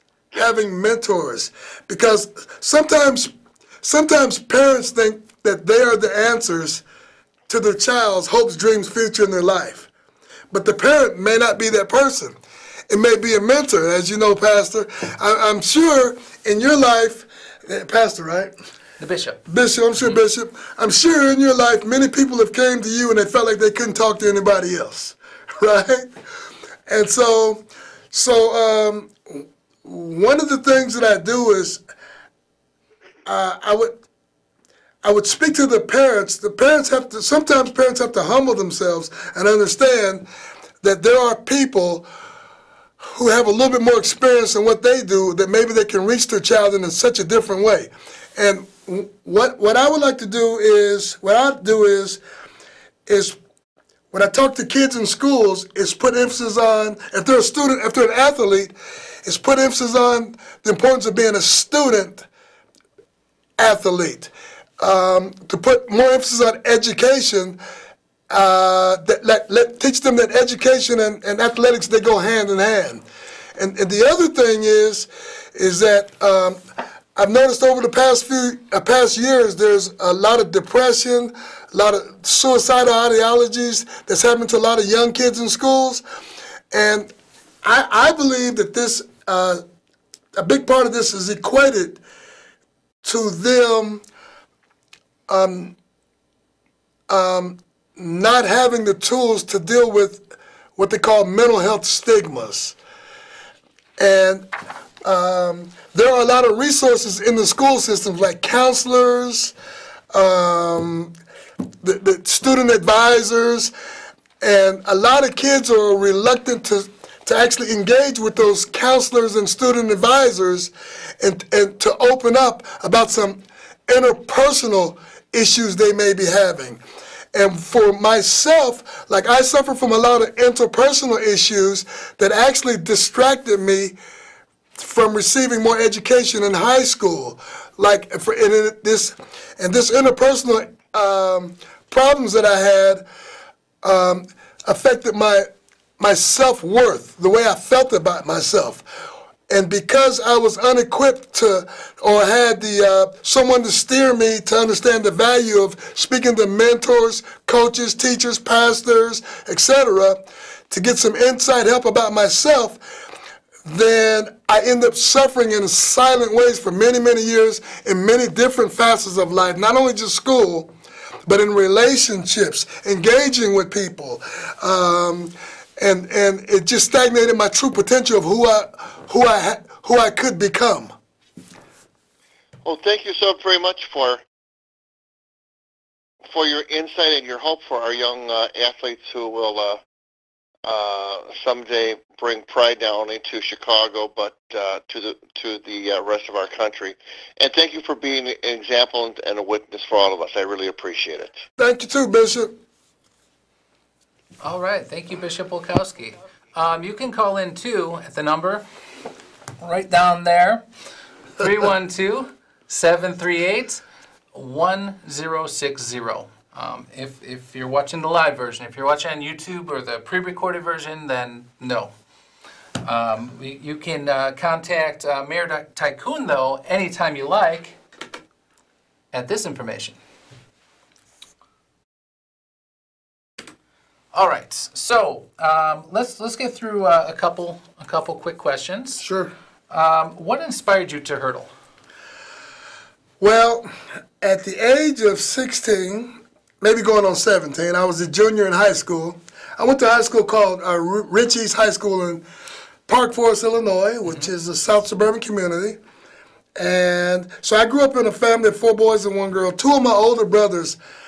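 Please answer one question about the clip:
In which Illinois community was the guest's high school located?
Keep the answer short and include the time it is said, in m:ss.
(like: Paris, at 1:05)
Park Forest, at 4:12.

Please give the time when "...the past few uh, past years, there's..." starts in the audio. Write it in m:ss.
1:17.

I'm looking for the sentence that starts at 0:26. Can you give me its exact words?
And so, so um, one of the things that I do is uh, I would I would speak to the parents.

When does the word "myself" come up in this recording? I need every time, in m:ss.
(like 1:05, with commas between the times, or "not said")
2:08, 2:28, 2:42.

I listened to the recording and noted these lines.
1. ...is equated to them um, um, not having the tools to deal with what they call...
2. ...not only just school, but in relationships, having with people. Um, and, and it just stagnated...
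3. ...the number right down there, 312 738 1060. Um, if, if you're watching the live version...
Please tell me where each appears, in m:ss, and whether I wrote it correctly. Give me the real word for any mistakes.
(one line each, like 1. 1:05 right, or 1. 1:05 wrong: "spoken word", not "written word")
1. 1:31 right
2. 2:49 wrong: "engaging", not "having"
3. 3:28 right.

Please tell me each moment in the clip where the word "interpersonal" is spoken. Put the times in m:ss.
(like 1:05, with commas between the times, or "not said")
2:03, 2:10, 2:19.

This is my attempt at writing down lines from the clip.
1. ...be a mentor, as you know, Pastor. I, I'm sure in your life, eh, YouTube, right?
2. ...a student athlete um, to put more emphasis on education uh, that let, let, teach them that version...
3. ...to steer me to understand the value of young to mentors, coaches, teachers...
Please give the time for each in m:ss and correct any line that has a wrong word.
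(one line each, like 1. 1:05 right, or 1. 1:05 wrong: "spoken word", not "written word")
1. 0:13 wrong: "Pastor", not "YouTube"
2. 1:01 wrong: "education", not "version"
3. 2:33 wrong: "speaking", not "young".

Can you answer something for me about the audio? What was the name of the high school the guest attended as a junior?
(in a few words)
Rich East High School.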